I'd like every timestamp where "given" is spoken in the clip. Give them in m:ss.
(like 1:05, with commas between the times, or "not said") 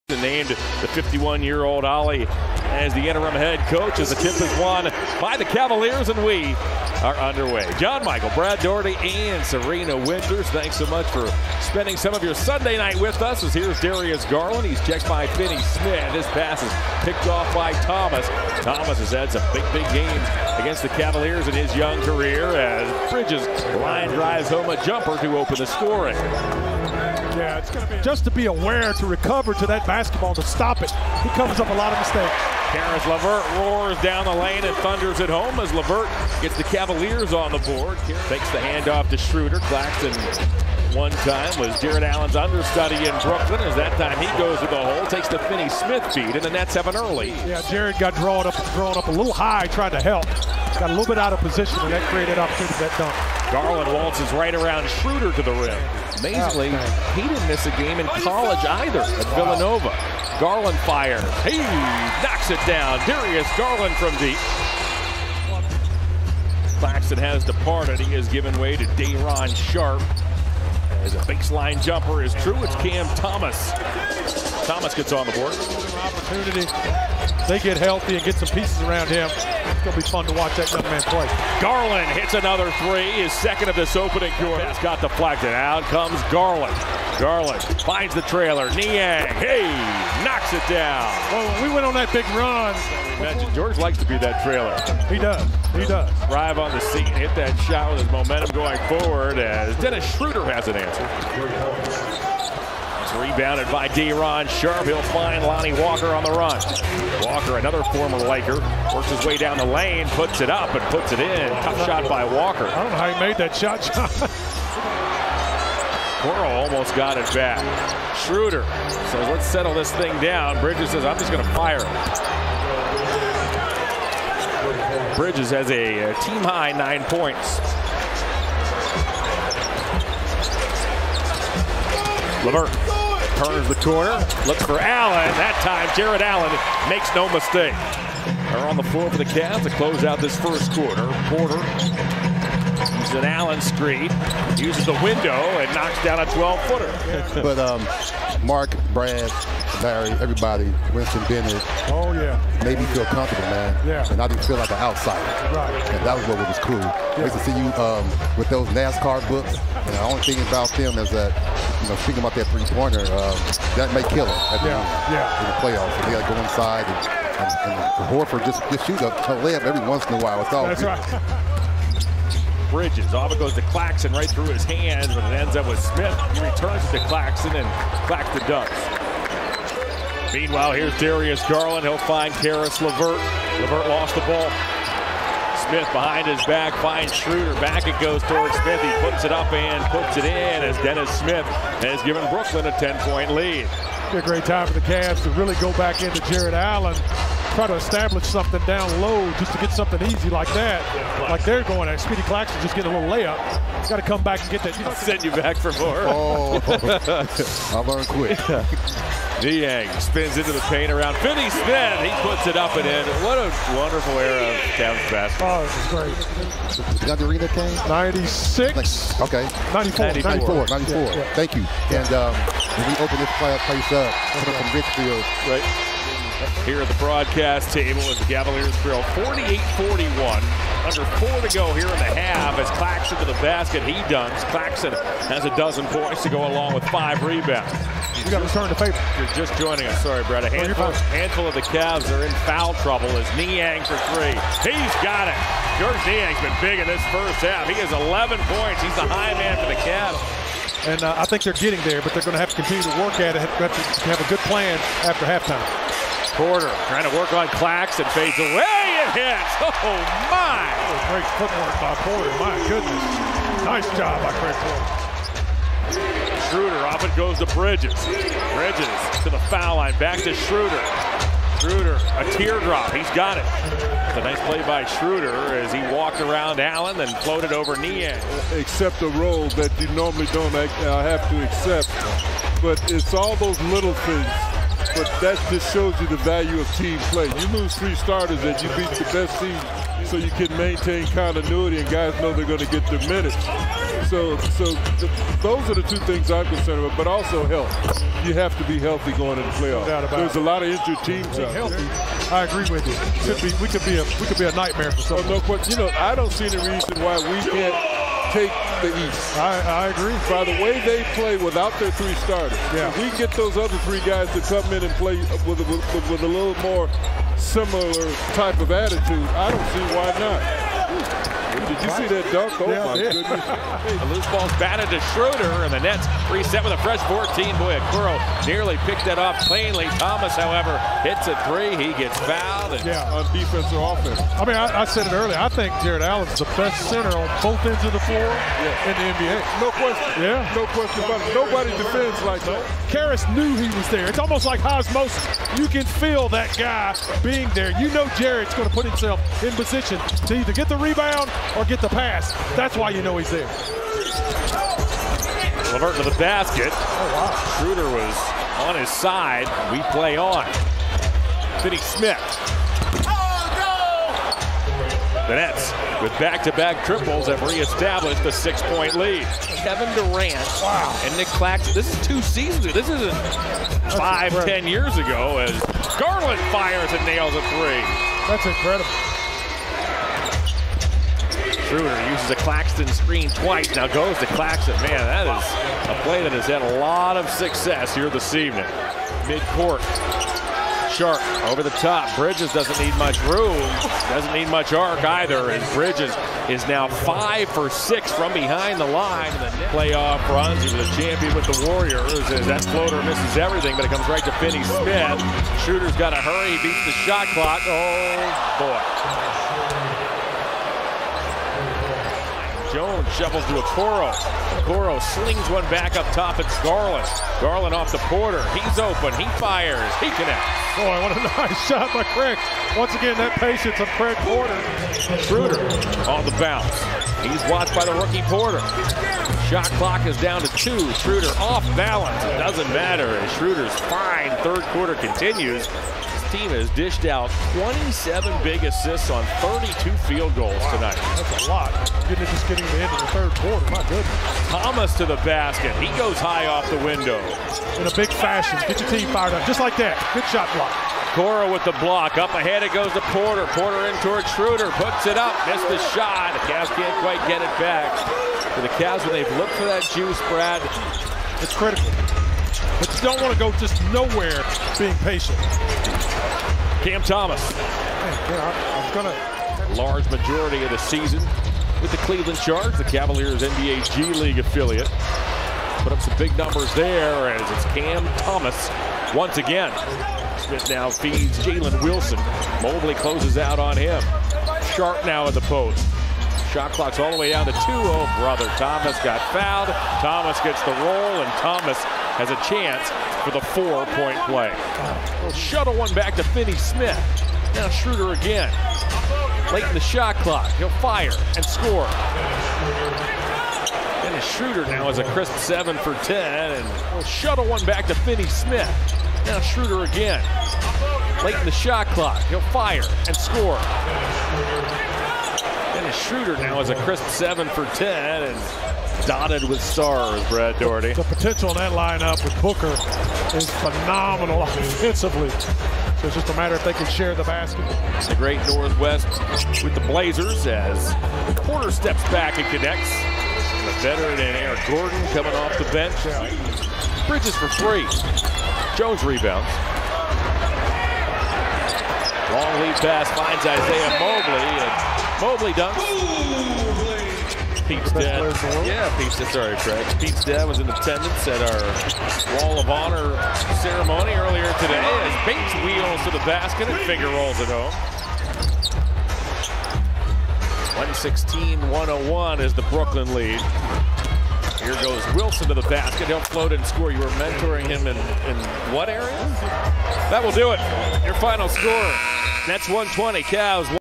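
1:08, 3:12.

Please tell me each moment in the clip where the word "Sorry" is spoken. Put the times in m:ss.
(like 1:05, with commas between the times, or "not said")
4:00, 9:09.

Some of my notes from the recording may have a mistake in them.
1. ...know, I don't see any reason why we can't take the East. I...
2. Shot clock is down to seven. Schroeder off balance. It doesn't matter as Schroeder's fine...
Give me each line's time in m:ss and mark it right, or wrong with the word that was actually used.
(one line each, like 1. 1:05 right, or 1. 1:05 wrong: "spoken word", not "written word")
1. 5:05 right
2. 7:09 wrong: "two", not "seven".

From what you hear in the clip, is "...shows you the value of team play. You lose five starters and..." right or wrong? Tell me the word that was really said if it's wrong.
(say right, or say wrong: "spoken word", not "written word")
wrong: "three", not "five".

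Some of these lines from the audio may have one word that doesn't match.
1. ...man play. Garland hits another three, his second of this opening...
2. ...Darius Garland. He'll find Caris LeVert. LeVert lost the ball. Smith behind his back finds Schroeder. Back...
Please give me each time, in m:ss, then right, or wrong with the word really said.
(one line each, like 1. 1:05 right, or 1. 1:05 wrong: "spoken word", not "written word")
1. 1:20 right
2. 3:00 right.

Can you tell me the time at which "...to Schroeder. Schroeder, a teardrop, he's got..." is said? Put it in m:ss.
4:30.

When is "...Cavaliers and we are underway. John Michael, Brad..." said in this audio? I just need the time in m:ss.
0:05.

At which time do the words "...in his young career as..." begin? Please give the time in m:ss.
0:21.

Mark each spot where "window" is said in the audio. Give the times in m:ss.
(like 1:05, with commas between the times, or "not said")
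2:25, 7:26.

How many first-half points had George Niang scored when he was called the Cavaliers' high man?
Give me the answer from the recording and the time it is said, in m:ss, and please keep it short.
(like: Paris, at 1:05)
11, at 4:07.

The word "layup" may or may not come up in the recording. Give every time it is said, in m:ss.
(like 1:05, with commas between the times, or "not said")
2:49, 3:23.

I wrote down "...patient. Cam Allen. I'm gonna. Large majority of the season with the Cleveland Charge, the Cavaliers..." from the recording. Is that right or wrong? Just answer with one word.
wrong.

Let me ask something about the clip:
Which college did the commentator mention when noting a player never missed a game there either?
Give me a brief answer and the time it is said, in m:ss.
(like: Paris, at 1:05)
Villanova, at 0:59.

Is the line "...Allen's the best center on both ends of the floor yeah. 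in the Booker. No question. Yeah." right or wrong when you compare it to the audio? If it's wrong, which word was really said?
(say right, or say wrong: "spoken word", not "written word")
wrong: "NBA", not "Booker".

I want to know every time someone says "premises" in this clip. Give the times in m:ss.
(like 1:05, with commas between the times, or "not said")
not said.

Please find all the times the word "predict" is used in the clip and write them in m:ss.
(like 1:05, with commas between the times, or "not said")
not said.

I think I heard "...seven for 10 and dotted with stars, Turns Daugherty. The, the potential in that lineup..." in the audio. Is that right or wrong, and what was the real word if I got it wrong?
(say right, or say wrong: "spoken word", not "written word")
wrong: "Brad", not "Turns".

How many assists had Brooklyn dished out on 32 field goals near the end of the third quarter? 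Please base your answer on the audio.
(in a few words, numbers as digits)
27.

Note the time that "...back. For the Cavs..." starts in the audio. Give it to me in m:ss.
7:37.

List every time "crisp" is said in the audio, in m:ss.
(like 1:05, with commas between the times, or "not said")
8:25, 8:36.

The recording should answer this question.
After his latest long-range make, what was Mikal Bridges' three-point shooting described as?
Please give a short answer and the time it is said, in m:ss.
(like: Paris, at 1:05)
5 for 6, at 6:36.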